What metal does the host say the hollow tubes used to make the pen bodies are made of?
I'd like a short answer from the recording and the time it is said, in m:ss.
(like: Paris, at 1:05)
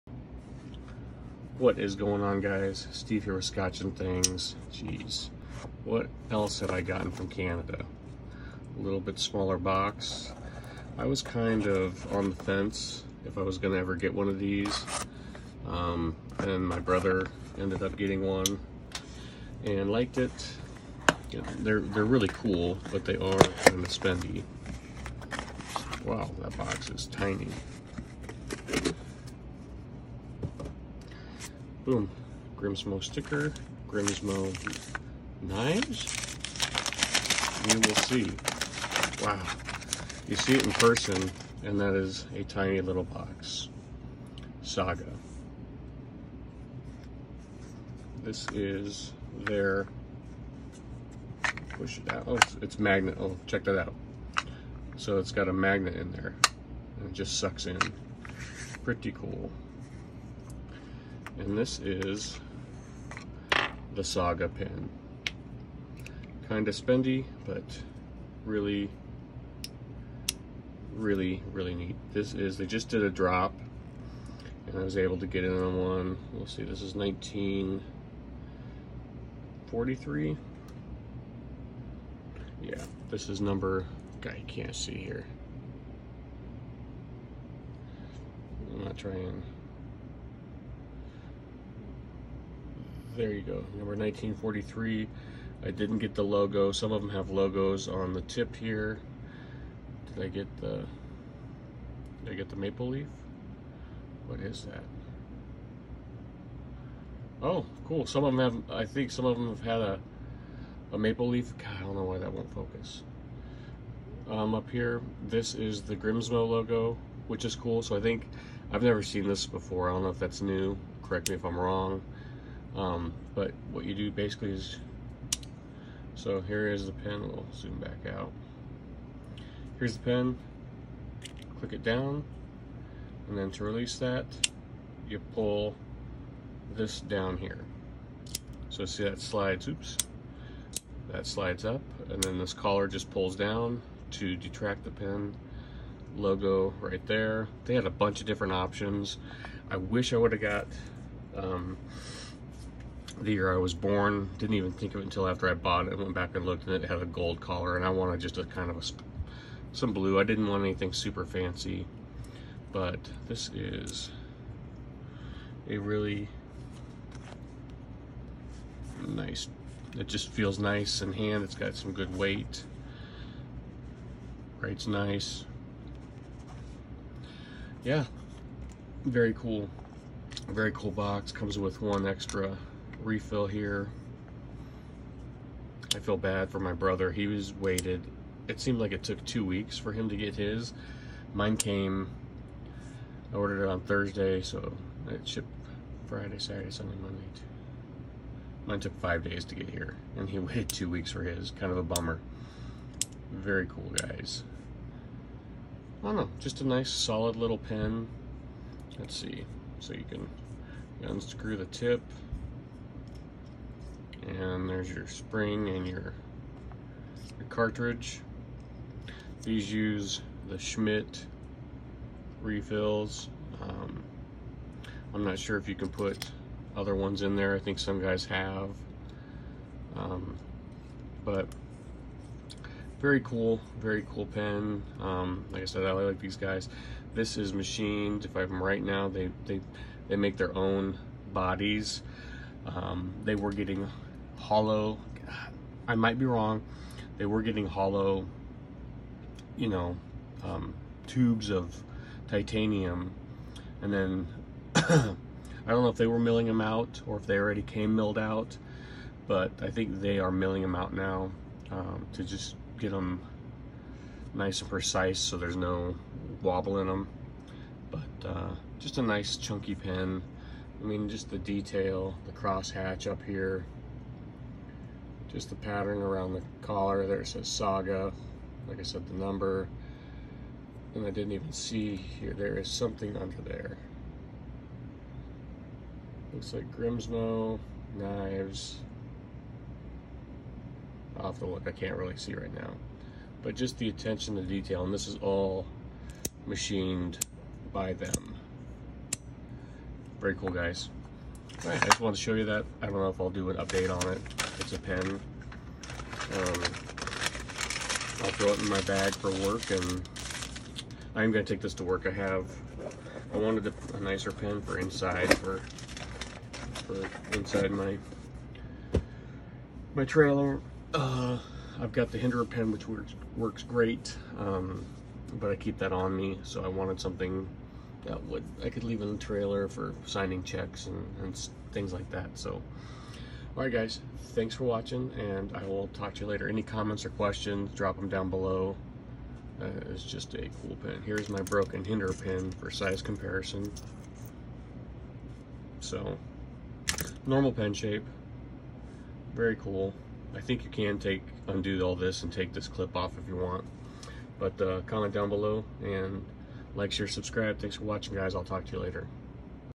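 titanium, at 4:12.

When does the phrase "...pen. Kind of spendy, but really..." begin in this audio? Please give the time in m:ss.
1:04.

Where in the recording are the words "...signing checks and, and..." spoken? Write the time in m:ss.
5:30.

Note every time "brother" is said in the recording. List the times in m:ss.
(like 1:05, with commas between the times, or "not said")
0:16, 3:06.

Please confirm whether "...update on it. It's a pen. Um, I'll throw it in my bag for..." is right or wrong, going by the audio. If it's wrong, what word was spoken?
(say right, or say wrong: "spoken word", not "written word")
right.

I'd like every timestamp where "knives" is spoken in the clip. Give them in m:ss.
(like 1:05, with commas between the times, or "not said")
0:35, 4:47.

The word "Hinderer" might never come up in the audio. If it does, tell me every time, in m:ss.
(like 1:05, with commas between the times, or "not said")
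5:22, 5:41.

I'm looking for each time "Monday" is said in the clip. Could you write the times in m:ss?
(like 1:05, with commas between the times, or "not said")
3:17.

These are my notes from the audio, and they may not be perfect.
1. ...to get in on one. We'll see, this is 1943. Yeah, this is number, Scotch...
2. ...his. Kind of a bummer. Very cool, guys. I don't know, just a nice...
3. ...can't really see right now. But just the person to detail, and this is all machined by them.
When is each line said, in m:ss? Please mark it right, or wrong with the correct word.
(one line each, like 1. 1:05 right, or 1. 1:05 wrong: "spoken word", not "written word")
1. 1:15 wrong: "Guy", not "Scotch"
2. 3:21 right
3. 4:51 wrong: "attention", not "person".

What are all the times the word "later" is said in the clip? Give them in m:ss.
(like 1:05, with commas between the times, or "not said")
5:36, 5:58.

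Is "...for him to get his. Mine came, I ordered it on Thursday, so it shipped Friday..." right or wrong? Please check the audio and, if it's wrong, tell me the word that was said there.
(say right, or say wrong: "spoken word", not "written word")
right.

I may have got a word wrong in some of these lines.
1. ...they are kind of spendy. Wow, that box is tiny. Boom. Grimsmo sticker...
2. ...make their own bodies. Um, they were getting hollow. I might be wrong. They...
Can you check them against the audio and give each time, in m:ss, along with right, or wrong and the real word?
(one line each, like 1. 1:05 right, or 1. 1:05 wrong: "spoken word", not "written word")
1. 0:23 right
2. 4:00 right.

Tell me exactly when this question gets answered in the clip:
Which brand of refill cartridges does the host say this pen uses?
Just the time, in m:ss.
3:40.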